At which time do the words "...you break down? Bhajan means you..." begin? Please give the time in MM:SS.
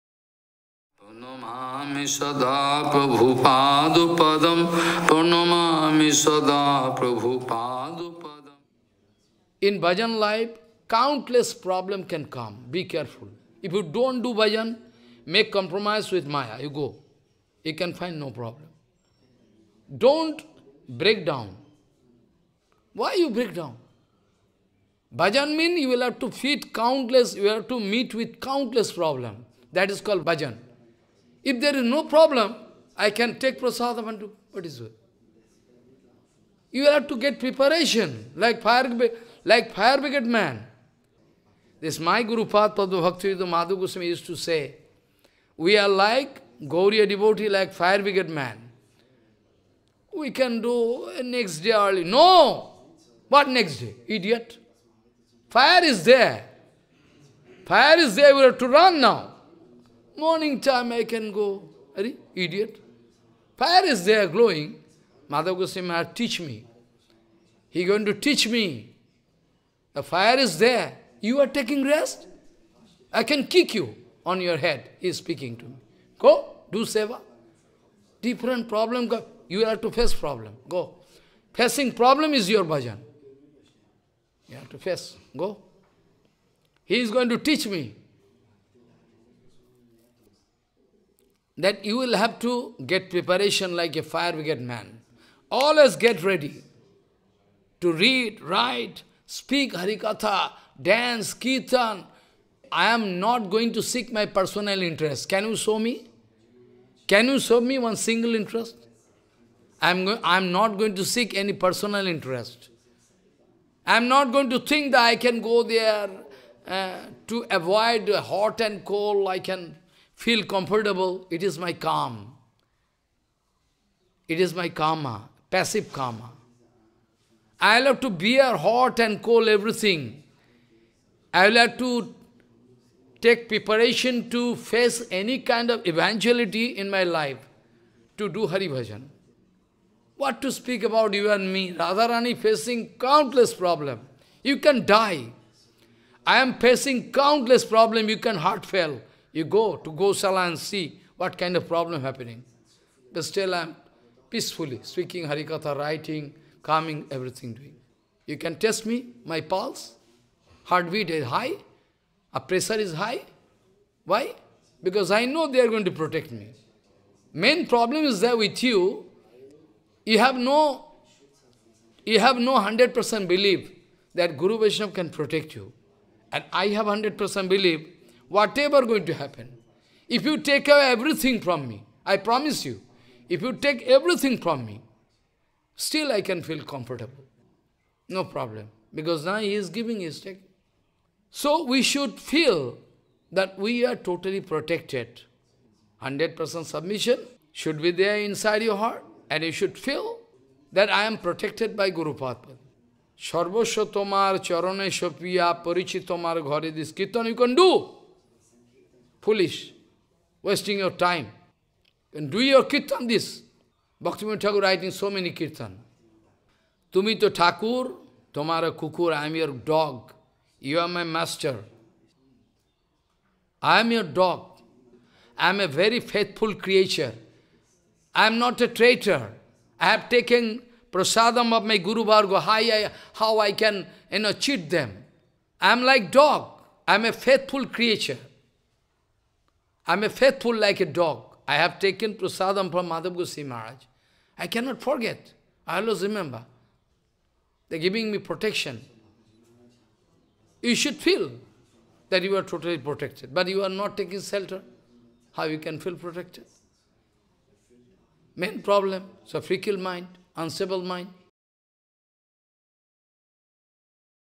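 00:23.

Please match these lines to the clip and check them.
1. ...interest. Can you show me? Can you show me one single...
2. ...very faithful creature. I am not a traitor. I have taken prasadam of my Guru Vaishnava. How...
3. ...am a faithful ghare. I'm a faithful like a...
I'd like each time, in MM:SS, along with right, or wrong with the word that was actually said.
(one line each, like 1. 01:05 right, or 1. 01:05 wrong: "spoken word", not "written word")
1. 01:44 right
2. 03:45 right
3. 03:56 wrong: "creature", not "ghare".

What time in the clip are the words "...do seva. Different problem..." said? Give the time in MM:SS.
01:16.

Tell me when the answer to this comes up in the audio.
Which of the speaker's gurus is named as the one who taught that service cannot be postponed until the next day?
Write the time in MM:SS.
00:43.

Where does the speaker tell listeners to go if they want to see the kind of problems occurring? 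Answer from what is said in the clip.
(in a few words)
Gosala.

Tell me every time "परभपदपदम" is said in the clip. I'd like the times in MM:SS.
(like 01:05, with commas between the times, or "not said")
00:02, 00:06.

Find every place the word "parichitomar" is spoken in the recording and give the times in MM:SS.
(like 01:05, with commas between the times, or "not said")
03:25.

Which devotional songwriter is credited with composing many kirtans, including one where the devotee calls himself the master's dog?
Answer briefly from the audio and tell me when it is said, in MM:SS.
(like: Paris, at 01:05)
Bhaktivinoda Thakur, at 03:34.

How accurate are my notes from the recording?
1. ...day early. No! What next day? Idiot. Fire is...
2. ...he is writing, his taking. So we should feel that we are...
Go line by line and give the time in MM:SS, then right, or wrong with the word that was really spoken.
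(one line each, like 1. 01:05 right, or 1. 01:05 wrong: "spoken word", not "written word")
1. 00:51 right
2. 03:09 wrong: "giving", not "writing".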